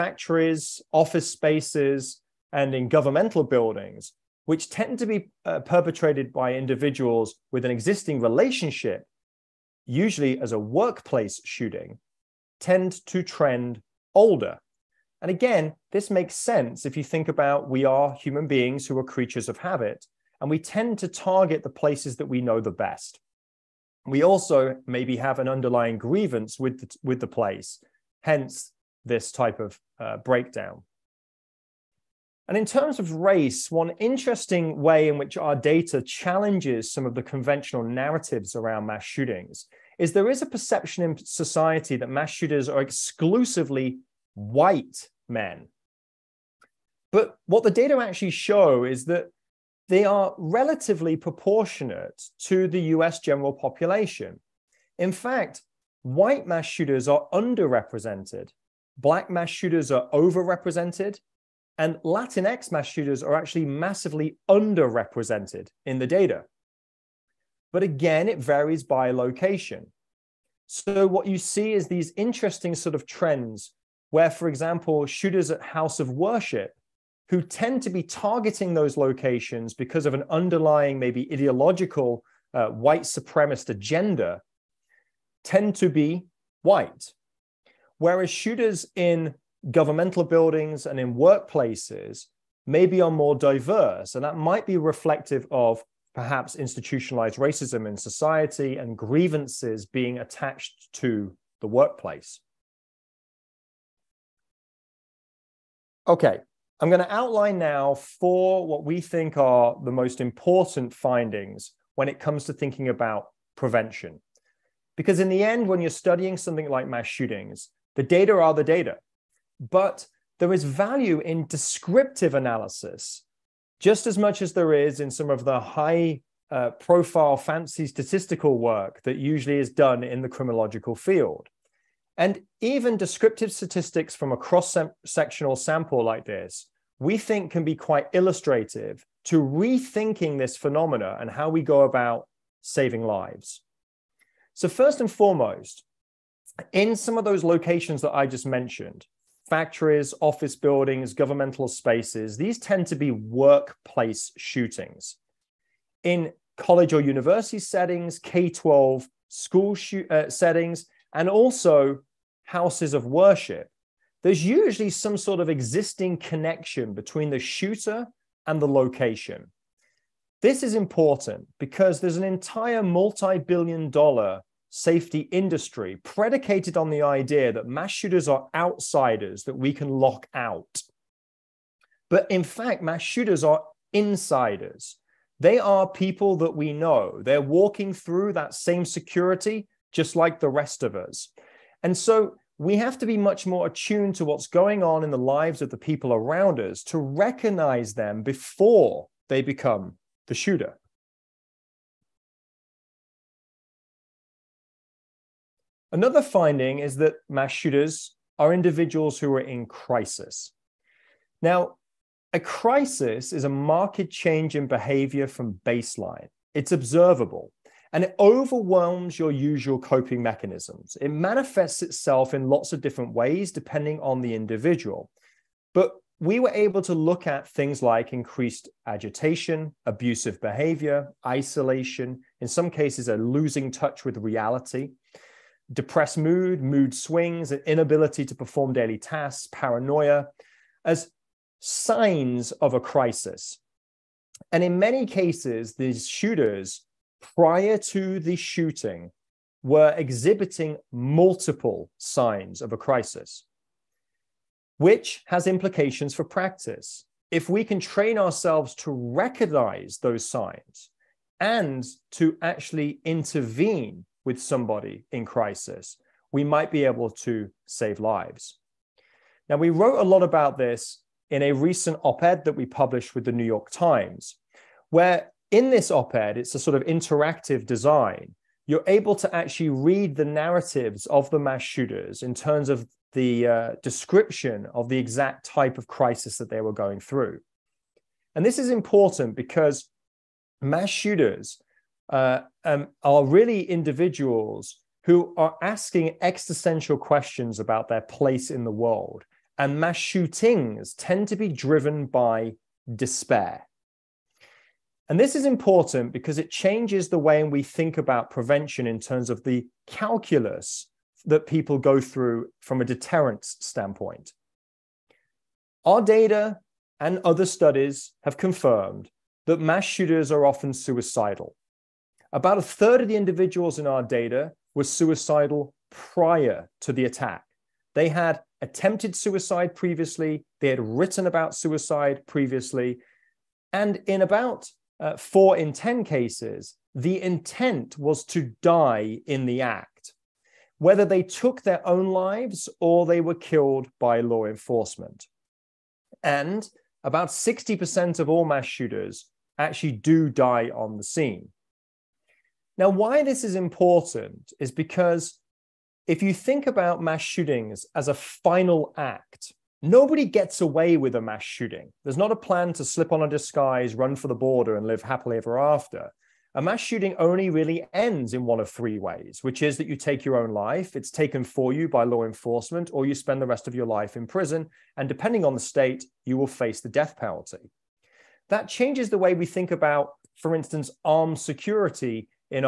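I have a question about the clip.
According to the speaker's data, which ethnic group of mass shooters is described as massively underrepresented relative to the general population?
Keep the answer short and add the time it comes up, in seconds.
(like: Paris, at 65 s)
Latinx, at 62 s.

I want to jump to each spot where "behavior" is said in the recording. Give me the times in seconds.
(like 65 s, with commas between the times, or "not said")
214 s, 230 s.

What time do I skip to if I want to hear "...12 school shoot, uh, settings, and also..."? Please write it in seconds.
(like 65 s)
158 s.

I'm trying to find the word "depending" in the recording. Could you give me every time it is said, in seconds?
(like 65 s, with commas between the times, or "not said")
223 s, 375 s.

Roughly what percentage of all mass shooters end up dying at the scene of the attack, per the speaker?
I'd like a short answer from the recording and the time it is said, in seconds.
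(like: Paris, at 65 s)
60%, at 347 s.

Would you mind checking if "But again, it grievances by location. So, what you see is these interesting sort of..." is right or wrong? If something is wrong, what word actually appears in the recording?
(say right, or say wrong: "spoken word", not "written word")
wrong: "varies", not "grievances".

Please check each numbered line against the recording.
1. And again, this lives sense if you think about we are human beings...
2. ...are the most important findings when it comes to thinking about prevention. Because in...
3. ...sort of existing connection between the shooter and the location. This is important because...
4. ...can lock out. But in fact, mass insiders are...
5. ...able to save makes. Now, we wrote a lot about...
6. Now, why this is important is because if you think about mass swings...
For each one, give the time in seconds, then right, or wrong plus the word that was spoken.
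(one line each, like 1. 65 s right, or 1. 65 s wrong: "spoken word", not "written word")
1. 15 s wrong: "makes", not "lives"
2. 109 s right
3. 165 s right
4. 179 s wrong: "shooters", not "insiders"
5. 266 s wrong: "lives", not "makes"
6. 352 s wrong: "shootings", not "swings".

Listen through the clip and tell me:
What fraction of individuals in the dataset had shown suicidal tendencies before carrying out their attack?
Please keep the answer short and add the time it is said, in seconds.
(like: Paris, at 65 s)
a third, at 322 s.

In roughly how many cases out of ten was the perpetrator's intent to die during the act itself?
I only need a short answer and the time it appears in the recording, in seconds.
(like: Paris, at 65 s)
4 in 10, at 335 s.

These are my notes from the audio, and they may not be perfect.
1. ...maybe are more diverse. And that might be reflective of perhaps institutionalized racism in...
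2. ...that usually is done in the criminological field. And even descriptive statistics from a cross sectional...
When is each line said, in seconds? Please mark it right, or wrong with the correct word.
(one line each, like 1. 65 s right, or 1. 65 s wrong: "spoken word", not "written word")
1. 92 s right
2. 129 s right.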